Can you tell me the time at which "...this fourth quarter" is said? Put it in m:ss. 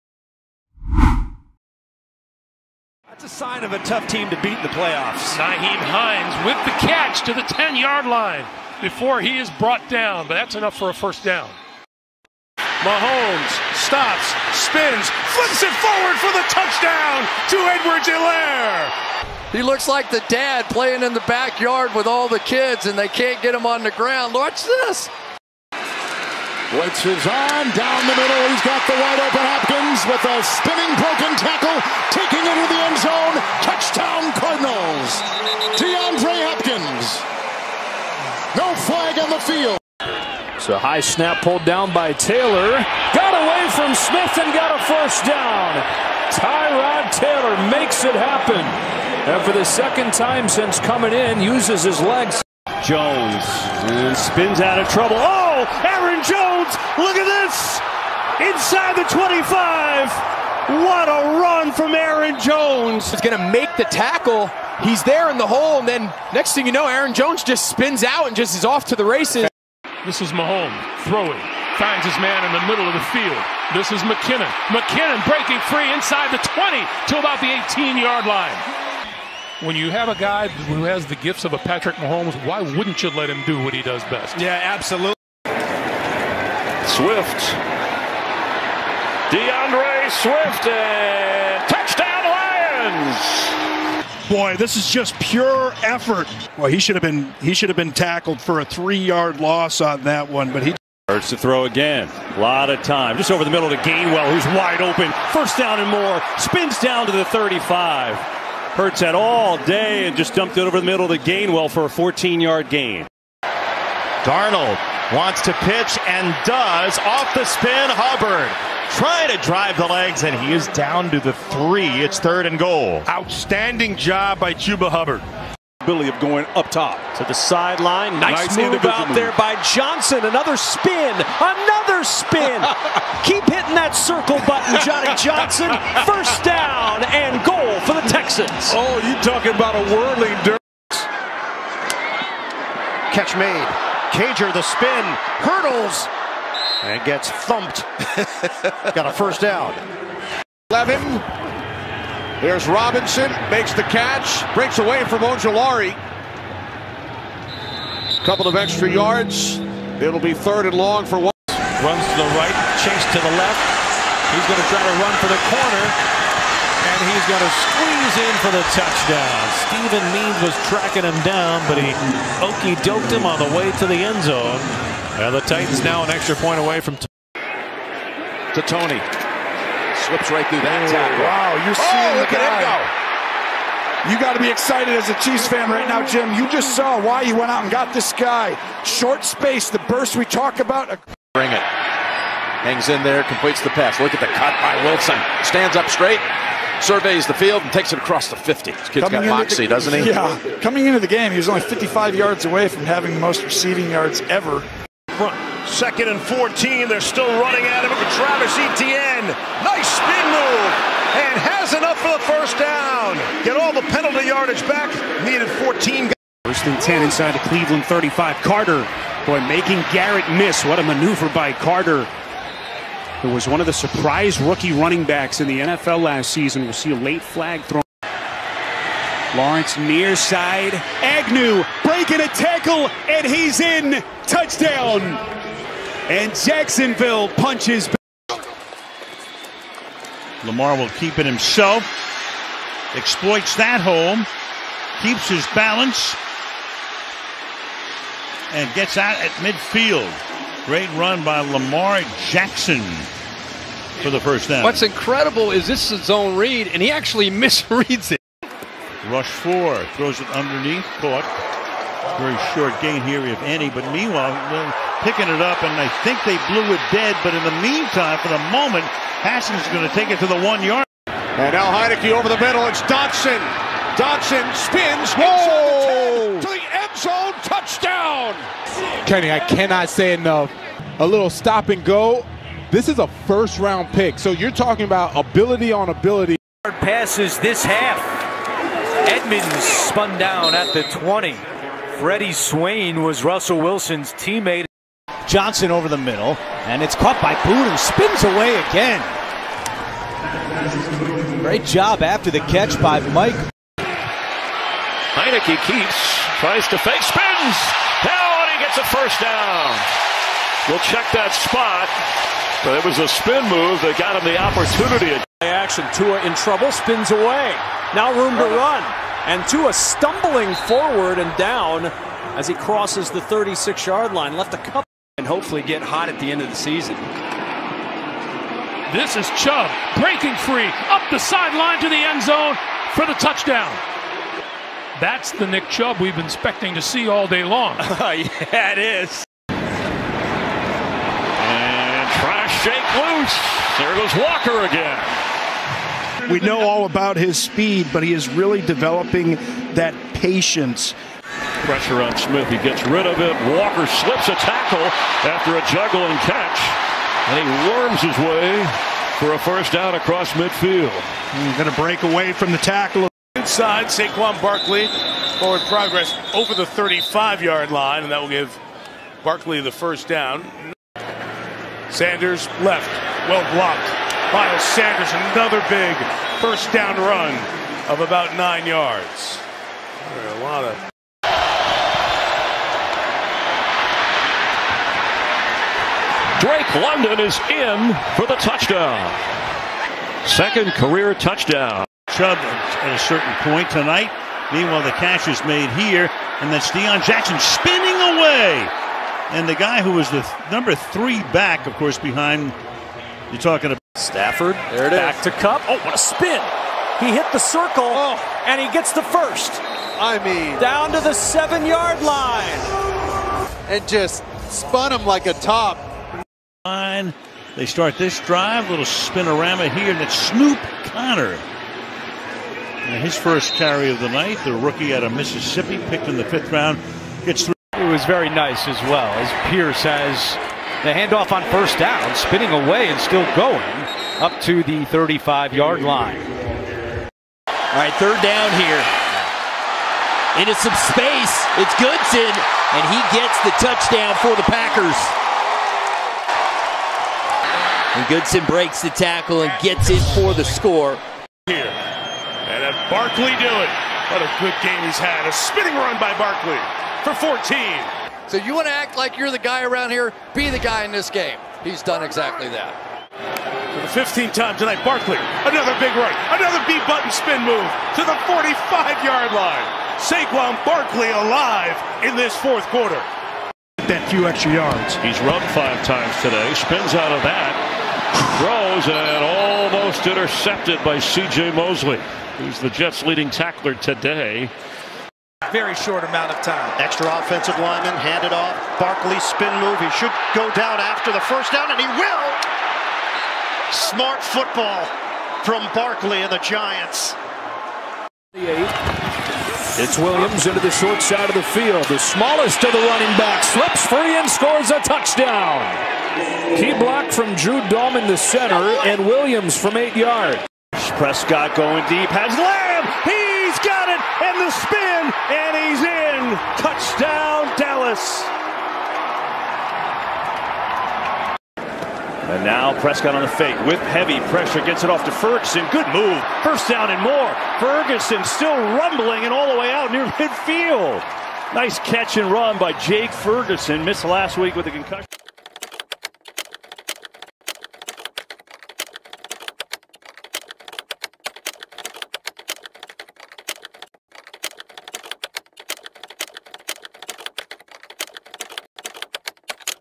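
7:52.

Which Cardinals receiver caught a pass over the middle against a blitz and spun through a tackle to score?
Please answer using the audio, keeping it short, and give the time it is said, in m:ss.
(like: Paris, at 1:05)
DeAndre Hopkins, at 0:35.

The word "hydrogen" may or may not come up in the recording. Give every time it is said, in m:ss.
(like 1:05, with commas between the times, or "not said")
not said.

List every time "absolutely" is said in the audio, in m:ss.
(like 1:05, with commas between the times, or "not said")
1:24.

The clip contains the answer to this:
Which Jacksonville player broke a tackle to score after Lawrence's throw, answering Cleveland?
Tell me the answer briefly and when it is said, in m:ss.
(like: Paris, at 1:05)
Agnew, at 3:51.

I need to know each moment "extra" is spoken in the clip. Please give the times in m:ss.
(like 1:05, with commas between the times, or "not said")
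2:38, 2:56, 7:54, 8:06.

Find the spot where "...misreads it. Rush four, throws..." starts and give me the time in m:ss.
4:17.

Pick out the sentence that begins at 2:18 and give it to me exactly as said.
Oh, you talking about a whirling dirt.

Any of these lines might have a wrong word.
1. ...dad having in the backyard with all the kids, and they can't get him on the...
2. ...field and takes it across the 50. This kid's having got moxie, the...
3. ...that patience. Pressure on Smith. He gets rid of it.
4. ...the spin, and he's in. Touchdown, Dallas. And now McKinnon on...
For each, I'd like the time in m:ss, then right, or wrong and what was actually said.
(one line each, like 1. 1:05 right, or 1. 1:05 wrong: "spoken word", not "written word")
1. 0:20 wrong: "playing", not "having"
2. 3:17 wrong: "coming", not "having"
3. 5:49 right
4. 8:34 wrong: "Prescott", not "McKinnon".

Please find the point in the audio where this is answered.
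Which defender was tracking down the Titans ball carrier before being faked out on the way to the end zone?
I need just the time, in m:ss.
2:49.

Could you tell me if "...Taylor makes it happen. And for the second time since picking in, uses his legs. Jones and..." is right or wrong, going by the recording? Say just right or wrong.
wrong.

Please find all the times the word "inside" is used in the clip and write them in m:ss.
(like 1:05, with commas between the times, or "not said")
0:58, 1:15, 3:37, 6:03.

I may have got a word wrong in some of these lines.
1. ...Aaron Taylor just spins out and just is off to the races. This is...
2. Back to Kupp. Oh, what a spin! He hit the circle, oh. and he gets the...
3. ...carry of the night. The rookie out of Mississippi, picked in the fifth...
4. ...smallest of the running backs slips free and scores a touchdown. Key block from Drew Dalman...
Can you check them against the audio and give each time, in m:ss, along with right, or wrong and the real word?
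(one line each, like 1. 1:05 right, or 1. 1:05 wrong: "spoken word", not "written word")
1. 1:06 wrong: "Jones", not "Taylor"
2. 6:44 right
3. 7:03 right
4. 8:21 right.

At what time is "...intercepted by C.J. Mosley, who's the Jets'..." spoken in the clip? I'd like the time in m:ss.
8:00.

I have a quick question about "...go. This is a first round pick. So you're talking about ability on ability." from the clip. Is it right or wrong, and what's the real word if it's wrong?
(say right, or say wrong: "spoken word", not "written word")
right.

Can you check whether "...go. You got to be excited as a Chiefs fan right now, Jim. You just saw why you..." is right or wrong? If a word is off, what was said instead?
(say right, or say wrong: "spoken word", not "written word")
right.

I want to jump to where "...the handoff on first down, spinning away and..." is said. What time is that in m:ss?
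7:10.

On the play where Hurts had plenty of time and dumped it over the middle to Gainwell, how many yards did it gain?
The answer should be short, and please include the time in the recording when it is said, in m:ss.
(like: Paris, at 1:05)
14, at 1:51.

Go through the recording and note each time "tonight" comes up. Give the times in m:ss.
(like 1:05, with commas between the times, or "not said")
6:33, 7:44.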